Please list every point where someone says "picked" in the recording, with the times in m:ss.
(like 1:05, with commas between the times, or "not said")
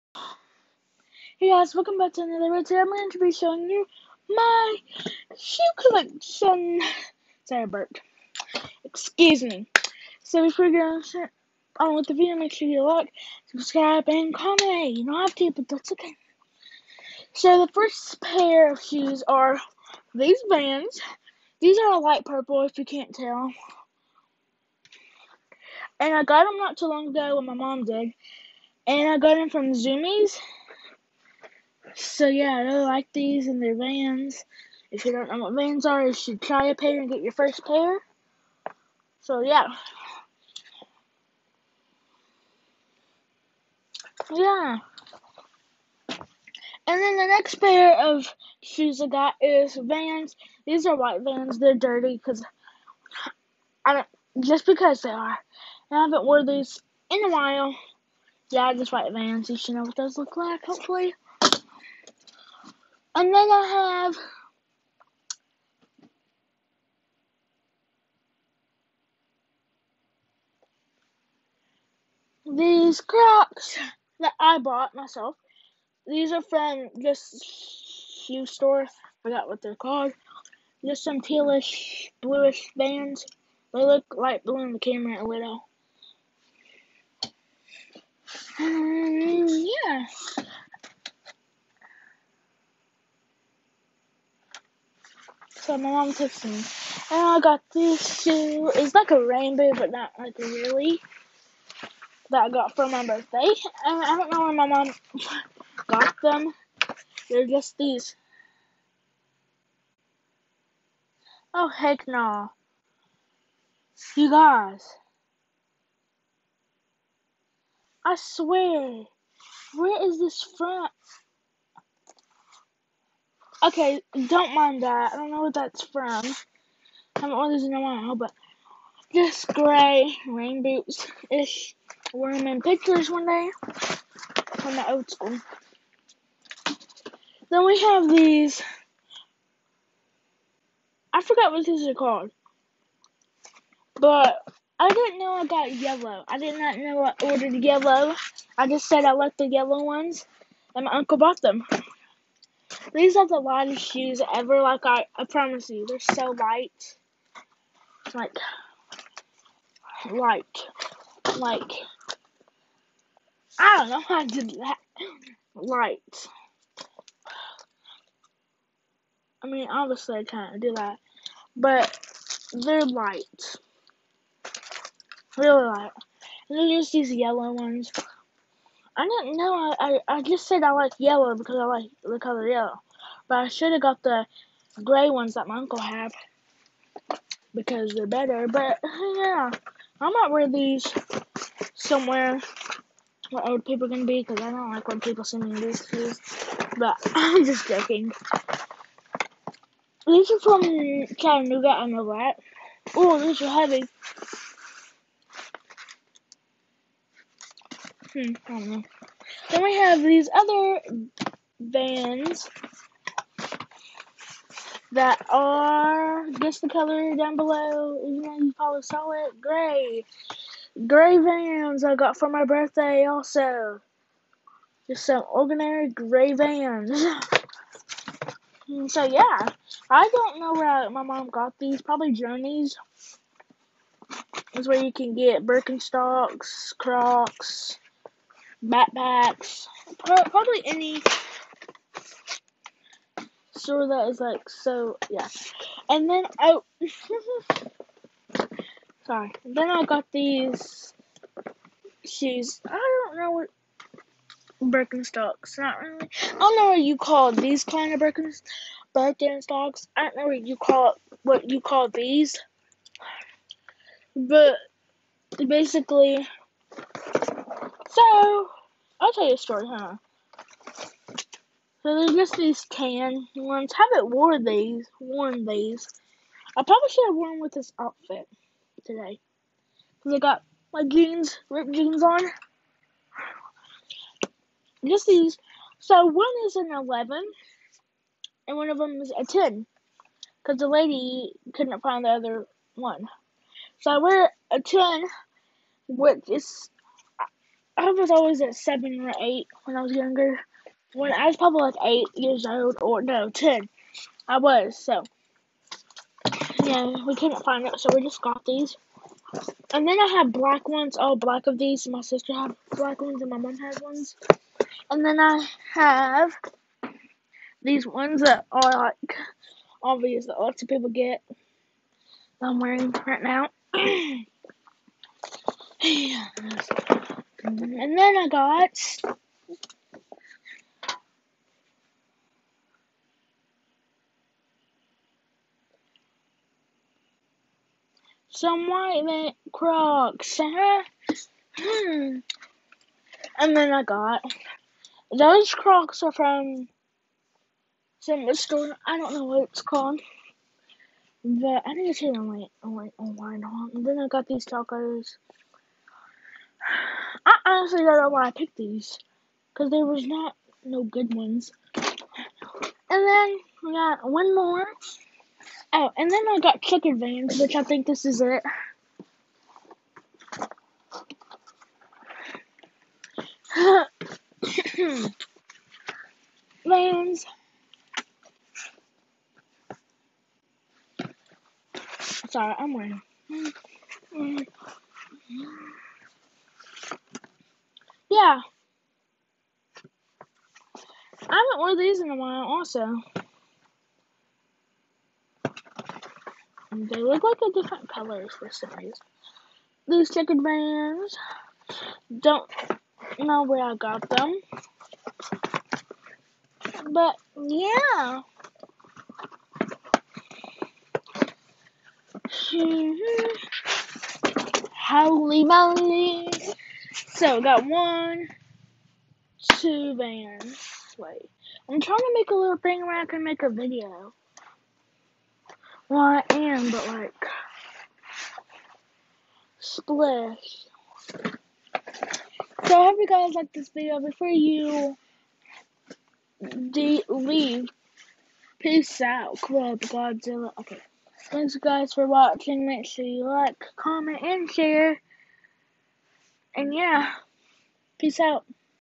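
5:58.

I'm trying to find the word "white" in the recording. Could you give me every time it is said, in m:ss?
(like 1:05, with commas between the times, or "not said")
0:50, 0:58, 5:38.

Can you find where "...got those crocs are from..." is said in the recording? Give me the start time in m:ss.
5:43.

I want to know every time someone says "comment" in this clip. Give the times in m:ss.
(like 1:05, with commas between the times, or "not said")
0:14, 7:23.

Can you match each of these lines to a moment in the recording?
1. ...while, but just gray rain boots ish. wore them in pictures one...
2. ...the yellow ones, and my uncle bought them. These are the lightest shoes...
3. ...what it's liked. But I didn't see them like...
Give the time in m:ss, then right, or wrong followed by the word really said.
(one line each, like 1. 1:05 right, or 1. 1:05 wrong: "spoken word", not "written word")
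1. 2:07 right
2. 2:29 right
3. 5:49 wrong: "called", not "liked".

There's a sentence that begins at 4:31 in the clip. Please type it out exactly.
So there's just these tan ones.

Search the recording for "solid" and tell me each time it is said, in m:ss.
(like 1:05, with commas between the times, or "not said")
3:38.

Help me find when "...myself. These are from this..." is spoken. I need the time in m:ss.
1:14.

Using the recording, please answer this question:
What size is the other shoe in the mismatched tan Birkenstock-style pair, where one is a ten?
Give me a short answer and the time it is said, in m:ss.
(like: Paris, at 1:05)
11, at 4:46.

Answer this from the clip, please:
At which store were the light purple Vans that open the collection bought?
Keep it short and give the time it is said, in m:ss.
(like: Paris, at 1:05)
Zumiez, at 0:29.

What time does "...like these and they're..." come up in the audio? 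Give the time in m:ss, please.
0:32.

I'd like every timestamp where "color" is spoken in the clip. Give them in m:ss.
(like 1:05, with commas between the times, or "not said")
3:02, 3:36, 6:37.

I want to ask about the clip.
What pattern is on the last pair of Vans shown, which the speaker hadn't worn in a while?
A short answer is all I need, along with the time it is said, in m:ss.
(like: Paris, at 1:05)
checkered, at 6:40.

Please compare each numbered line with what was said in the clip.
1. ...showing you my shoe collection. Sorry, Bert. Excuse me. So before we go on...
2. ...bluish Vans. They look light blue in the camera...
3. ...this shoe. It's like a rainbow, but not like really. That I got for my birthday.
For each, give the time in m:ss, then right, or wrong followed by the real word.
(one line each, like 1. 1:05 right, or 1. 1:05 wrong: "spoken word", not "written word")
1. 0:03 right
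2. 1:22 right
3. 1:37 right.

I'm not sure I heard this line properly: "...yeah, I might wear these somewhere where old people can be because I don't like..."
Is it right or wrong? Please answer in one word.
right.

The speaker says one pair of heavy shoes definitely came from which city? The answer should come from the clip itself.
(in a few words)
Chattanooga.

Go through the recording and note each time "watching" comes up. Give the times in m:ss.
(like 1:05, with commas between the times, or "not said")
7:22.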